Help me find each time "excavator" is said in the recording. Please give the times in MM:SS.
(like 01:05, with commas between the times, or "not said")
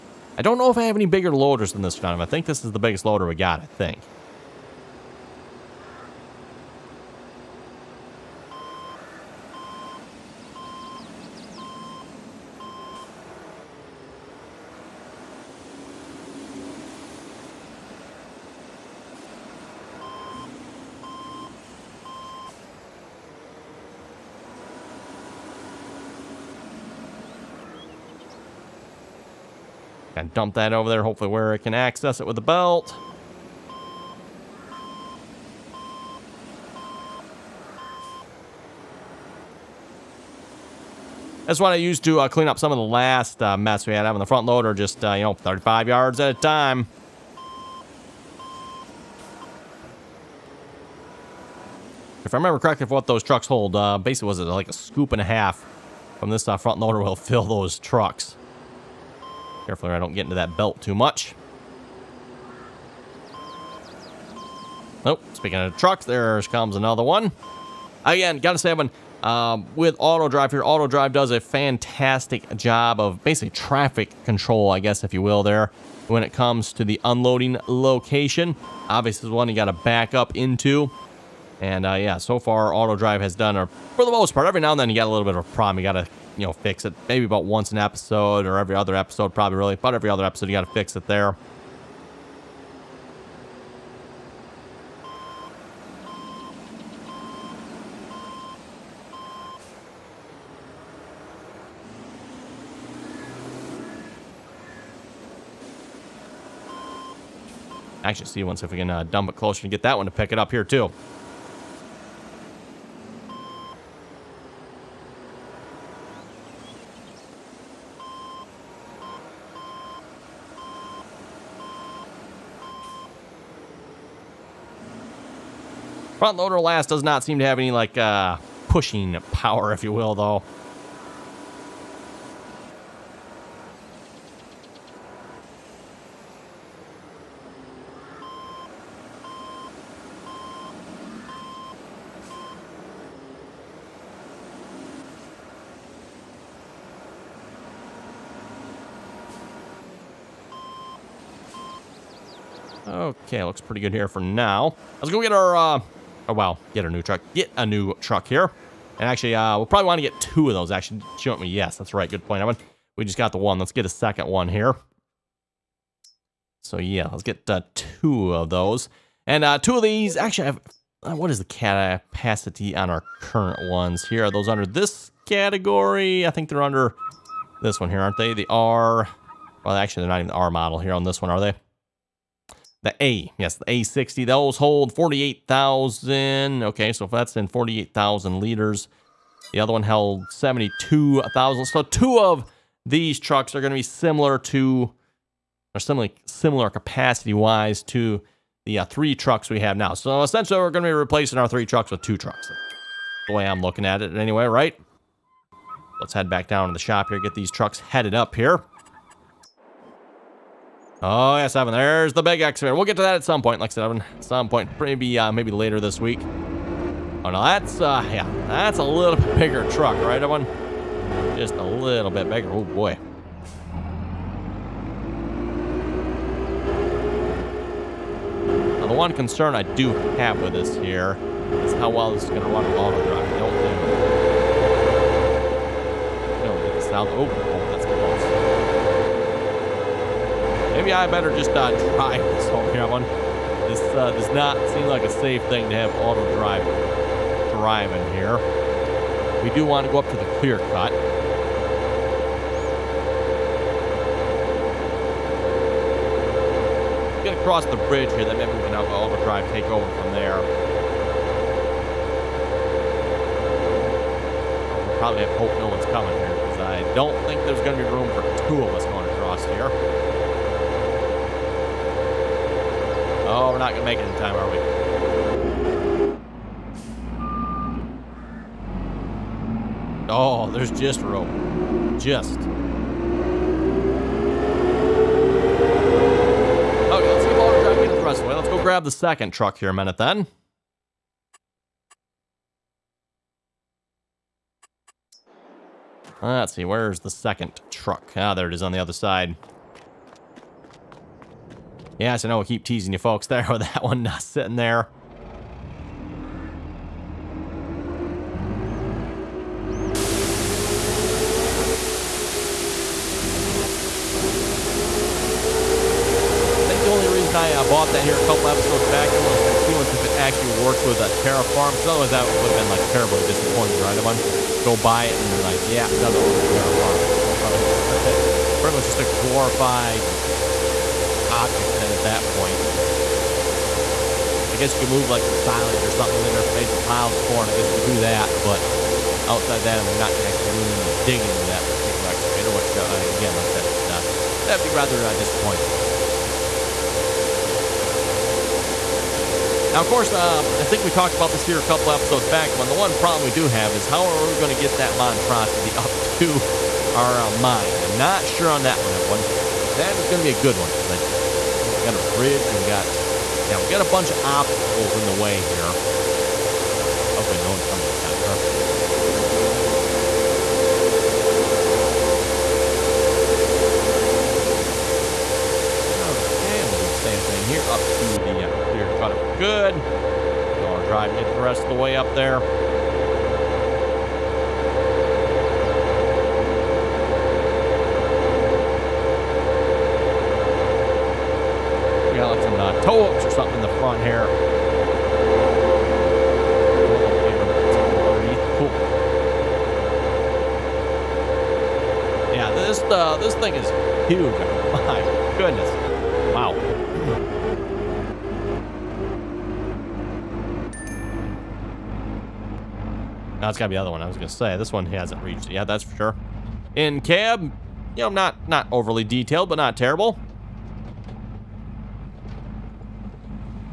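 03:32, 05:42.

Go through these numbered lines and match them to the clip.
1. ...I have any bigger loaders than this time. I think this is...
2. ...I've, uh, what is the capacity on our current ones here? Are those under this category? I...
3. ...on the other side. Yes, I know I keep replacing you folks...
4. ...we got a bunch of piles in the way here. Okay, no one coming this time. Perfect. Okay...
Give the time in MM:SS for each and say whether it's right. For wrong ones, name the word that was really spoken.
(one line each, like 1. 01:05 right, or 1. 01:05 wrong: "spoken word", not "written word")
1. 00:00 right
2. 02:50 right
3. 04:58 wrong: "teasing", not "replacing"
4. 06:03 wrong: "obstacles", not "piles".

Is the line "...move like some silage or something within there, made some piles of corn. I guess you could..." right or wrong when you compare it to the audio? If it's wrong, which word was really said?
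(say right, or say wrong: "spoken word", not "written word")
right.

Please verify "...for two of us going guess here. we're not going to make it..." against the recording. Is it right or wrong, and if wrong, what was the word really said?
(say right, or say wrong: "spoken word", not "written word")
wrong: "across", not "guess".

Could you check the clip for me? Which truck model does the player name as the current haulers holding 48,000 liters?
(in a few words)
A60.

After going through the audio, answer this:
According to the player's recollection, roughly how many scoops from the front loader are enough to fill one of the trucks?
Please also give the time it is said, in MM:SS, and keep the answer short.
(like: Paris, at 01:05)
a scoop and a half, at 00:54.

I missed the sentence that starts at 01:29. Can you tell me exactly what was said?
About every other episode, you got to fix it there.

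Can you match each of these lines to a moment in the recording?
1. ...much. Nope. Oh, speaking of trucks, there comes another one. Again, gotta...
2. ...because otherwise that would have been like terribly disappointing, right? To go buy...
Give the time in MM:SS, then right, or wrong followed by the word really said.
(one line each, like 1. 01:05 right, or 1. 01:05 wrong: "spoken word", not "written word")
1. 01:00 right
2. 05:21 right.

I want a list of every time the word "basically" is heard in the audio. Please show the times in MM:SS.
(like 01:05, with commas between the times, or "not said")
00:53, 01:13.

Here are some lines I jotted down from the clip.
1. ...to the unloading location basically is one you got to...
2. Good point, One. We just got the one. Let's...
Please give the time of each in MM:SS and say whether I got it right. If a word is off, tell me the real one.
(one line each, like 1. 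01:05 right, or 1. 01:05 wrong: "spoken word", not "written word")
1. 01:16 wrong: "obviously", not "basically"
2. 02:42 wrong: "Evan", not "One".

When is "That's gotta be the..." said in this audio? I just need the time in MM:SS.
06:53.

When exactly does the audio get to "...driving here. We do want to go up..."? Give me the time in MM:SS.
04:07.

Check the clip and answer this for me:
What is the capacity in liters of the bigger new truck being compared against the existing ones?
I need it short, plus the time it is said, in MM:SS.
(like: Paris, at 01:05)
72,000, at 03:10.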